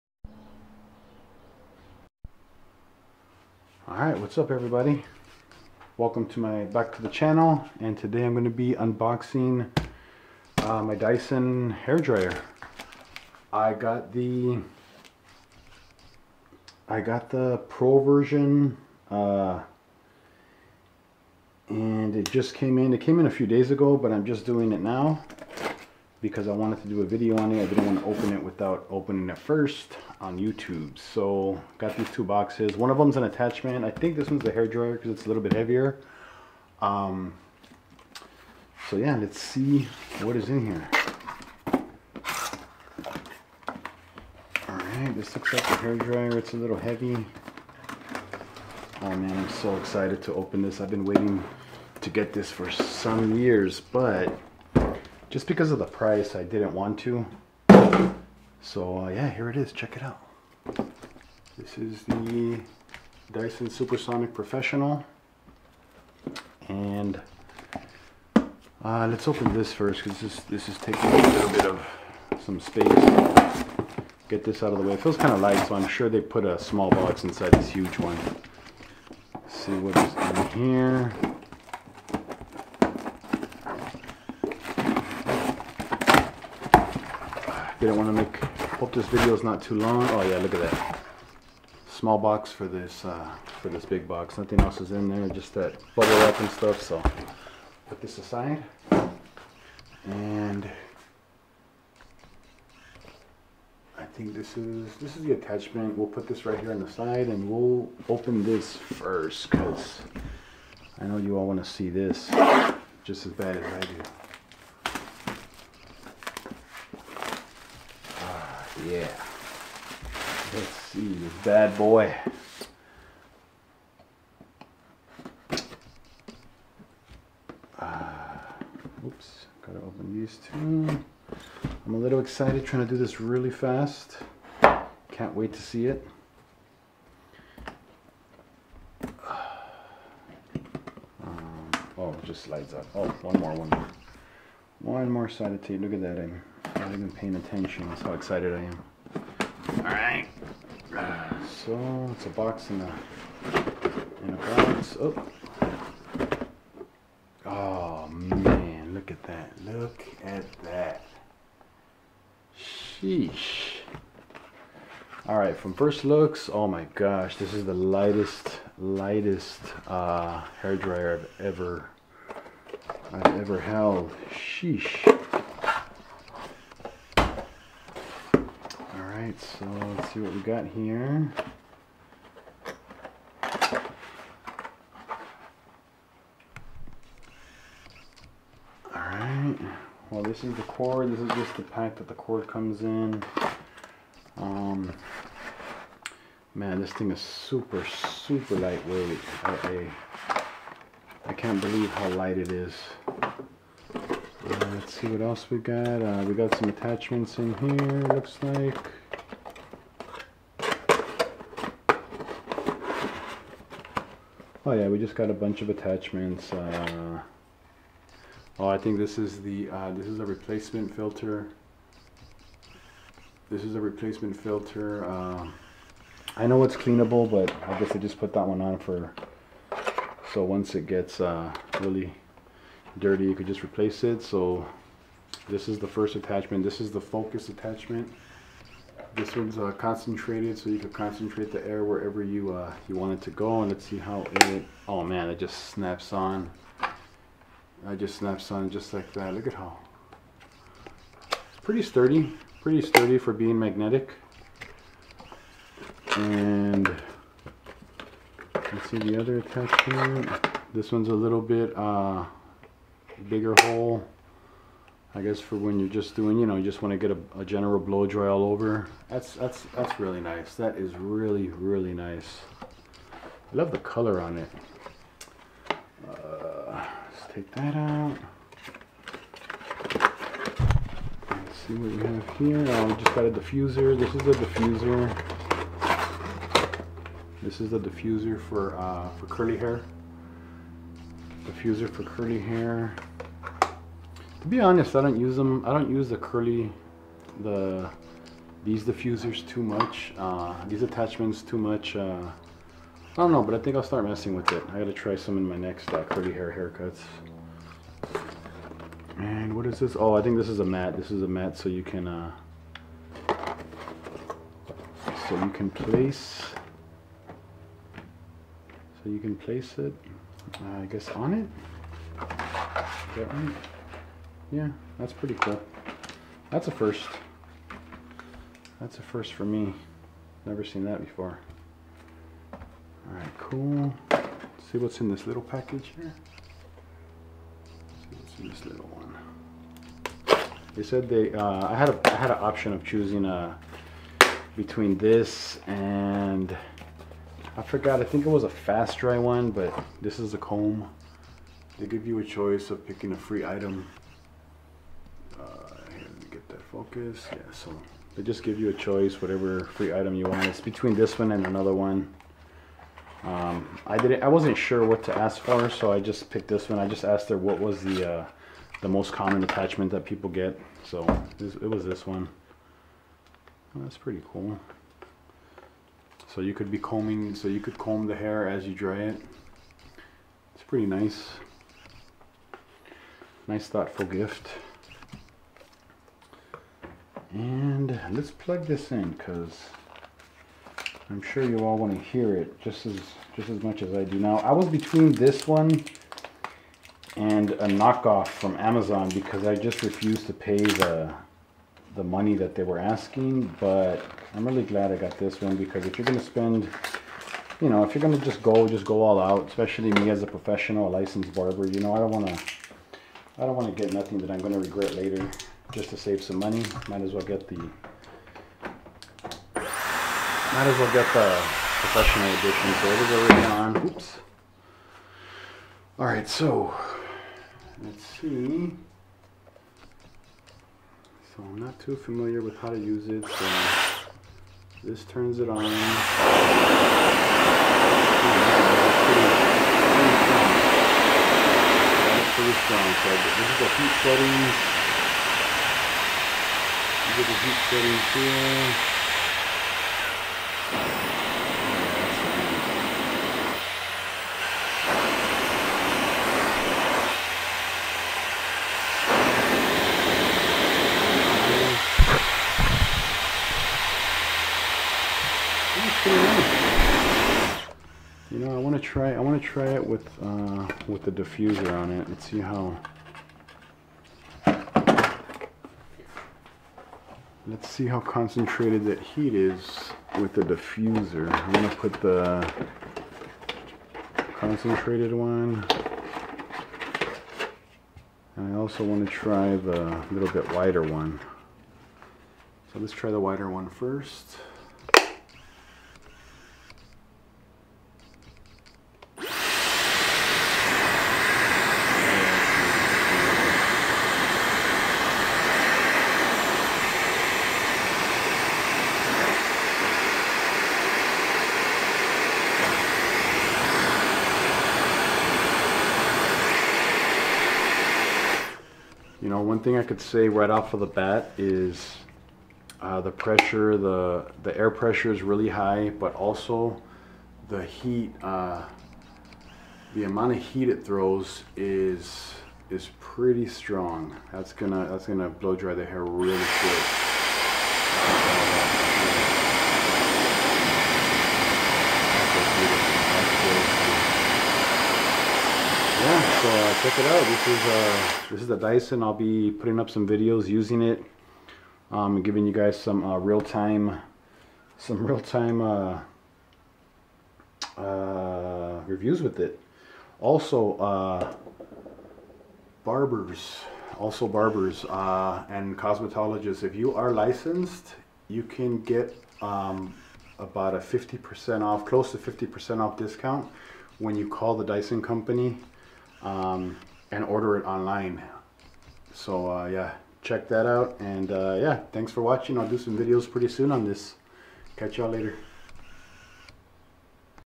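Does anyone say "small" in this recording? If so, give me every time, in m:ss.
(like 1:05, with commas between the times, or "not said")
1:16, 1:31.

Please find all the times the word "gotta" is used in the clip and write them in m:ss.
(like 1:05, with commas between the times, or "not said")
2:09, 5:04.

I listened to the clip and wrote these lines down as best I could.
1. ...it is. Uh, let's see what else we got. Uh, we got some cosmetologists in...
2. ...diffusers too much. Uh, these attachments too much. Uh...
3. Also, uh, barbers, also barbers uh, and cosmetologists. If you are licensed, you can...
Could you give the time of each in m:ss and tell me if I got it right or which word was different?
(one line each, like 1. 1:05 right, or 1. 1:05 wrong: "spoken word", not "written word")
1. 3:22 wrong: "attachments", not "cosmetologists"
2. 4:58 right
3. 9:20 right.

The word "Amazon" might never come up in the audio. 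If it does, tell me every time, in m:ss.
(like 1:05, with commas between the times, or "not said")
6:38.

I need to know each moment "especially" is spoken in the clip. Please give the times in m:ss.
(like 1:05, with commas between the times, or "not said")
6:49.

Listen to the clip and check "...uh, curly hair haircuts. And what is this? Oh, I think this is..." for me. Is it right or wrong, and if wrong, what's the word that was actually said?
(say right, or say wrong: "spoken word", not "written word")
right.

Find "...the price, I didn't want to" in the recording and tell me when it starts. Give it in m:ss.
0:55.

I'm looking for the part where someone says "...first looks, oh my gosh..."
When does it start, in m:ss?
2:45.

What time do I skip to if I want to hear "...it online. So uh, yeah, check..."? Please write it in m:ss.
9:37.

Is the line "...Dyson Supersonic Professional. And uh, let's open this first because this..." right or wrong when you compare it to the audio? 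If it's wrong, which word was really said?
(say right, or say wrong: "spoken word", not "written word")
right.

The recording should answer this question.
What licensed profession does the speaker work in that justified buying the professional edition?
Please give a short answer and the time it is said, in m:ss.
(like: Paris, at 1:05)
barber, at 6:50.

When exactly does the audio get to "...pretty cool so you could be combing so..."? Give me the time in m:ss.
6:13.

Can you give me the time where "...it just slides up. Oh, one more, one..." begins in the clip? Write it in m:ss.
2:22.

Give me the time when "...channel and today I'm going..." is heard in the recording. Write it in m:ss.
0:07.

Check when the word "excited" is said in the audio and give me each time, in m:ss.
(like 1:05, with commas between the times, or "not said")
0:49, 2:12, 2:28.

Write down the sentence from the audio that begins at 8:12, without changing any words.
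So let's try the wider one first.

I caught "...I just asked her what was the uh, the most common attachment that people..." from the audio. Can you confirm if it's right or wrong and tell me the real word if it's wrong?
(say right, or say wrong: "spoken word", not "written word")
right.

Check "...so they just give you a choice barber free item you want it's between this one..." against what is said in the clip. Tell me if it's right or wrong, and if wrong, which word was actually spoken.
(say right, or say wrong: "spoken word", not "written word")
wrong: "whatever", not "barber".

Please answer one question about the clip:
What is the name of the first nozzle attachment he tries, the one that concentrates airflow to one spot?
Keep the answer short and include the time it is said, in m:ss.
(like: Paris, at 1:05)
focus attachment, at 3:57.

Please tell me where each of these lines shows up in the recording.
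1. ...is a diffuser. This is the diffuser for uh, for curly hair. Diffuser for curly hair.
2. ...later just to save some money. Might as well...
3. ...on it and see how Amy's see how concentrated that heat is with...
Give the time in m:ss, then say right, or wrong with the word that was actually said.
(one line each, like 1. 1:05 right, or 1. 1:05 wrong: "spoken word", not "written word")
1. 4:44 right
2. 6:54 right
3. 7:51 wrong: "Let", not "Amy".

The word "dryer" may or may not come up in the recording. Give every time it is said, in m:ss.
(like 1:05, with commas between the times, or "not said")
0:11, 0:34, 0:45, 2:50.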